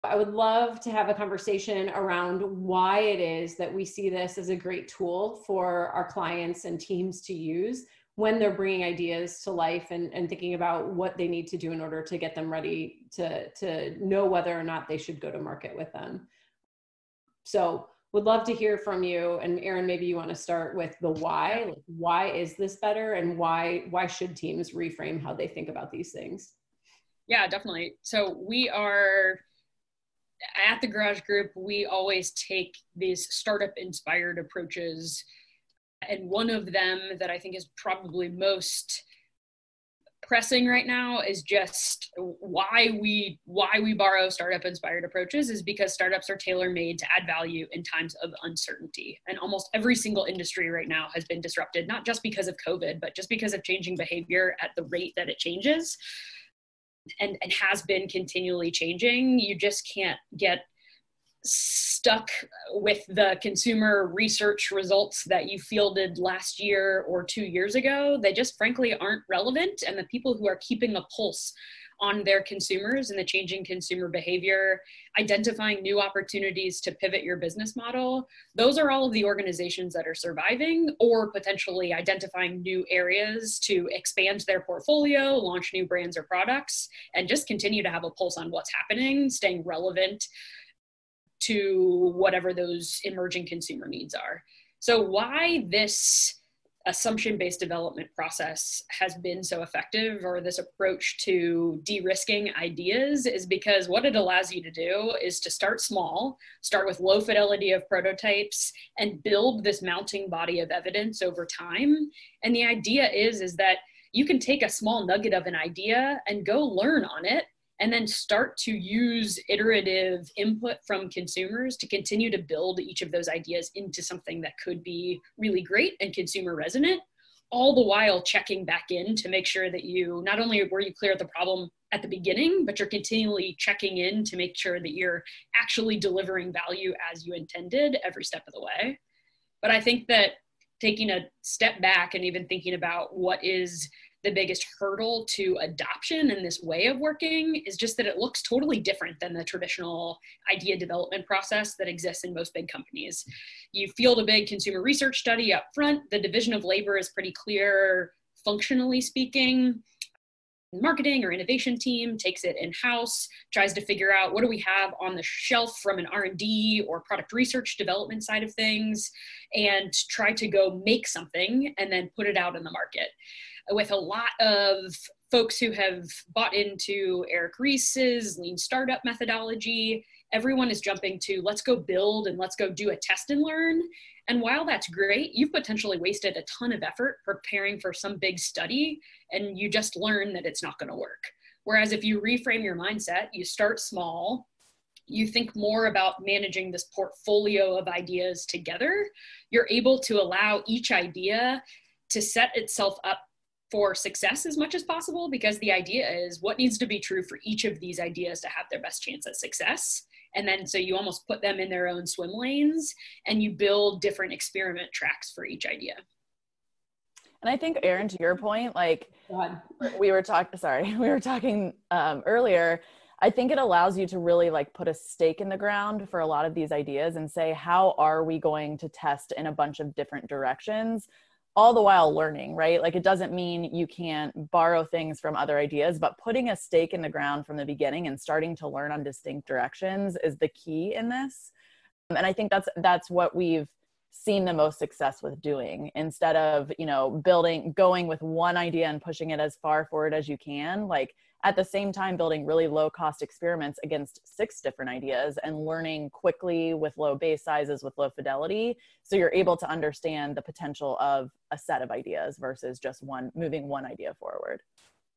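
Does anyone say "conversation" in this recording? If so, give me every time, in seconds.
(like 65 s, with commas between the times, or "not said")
1 s.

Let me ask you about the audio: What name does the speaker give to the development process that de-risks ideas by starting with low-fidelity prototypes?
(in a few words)
assumption based development.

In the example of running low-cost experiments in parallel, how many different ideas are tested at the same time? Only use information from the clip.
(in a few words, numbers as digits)
6.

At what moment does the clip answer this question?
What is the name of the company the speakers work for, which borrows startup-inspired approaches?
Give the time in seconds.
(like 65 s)
30 s.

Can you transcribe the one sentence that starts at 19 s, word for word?
And Aaron, maybe you want to start with the why.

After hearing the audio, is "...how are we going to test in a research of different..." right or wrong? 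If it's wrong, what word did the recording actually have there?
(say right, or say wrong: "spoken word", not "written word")
wrong: "bunch", not "research".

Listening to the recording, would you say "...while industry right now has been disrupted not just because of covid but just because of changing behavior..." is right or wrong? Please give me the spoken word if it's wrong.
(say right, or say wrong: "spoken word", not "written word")
wrong: "single", not "while".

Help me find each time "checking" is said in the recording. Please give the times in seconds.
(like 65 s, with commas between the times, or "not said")
128 s, 133 s.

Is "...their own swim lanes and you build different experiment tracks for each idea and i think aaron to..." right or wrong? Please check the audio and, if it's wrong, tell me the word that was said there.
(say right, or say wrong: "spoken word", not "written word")
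right.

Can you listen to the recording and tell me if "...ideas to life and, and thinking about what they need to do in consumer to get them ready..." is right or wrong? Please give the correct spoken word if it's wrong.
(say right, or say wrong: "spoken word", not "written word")
wrong: "order", not "consumer".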